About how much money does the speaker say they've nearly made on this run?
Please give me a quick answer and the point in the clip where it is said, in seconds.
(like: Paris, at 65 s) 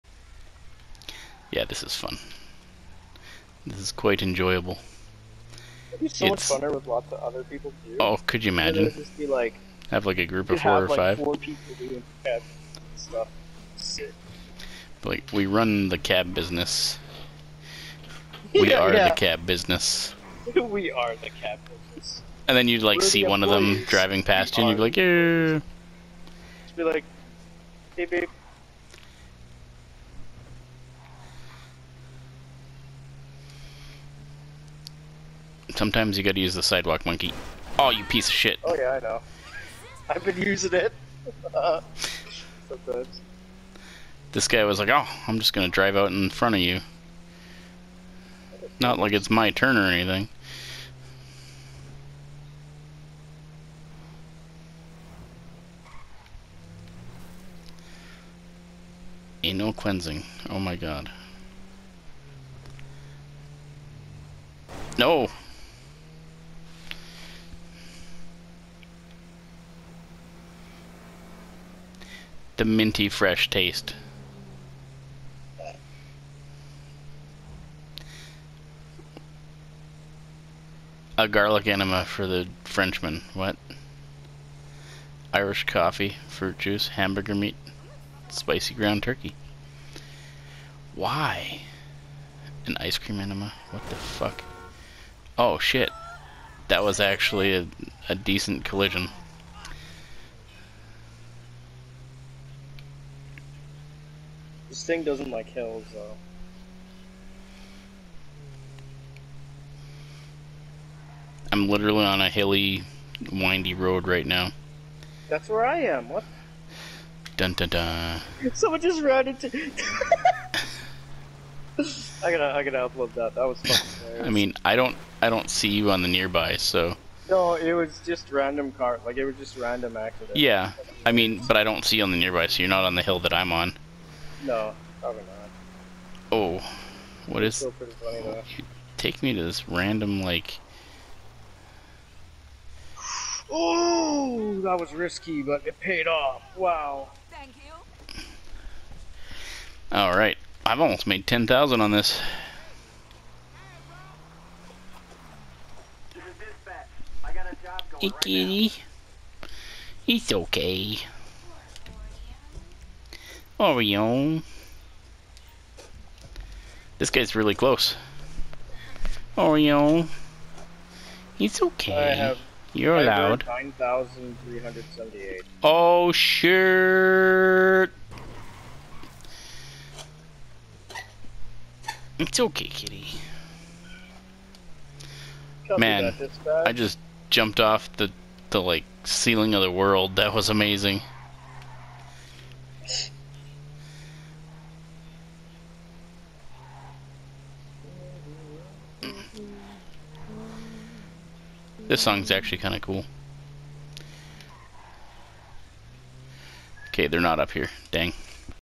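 10,000, at 151 s.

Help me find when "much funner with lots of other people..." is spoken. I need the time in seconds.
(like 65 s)
6 s.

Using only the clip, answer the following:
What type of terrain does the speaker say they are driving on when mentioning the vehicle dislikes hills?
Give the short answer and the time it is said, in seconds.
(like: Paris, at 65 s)
Hilly, windy road, at 112 s.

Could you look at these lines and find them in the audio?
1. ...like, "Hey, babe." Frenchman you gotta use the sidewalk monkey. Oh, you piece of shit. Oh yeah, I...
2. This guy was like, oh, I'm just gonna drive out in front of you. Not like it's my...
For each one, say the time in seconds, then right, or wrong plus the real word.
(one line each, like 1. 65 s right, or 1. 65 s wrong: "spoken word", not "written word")
1. 26 s wrong: "Sometimes", not "Frenchman"
2. 44 s right.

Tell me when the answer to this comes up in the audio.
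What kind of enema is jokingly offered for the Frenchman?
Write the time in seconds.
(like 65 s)
81 s.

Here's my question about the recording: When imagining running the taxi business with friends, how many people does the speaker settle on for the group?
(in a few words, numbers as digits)
4.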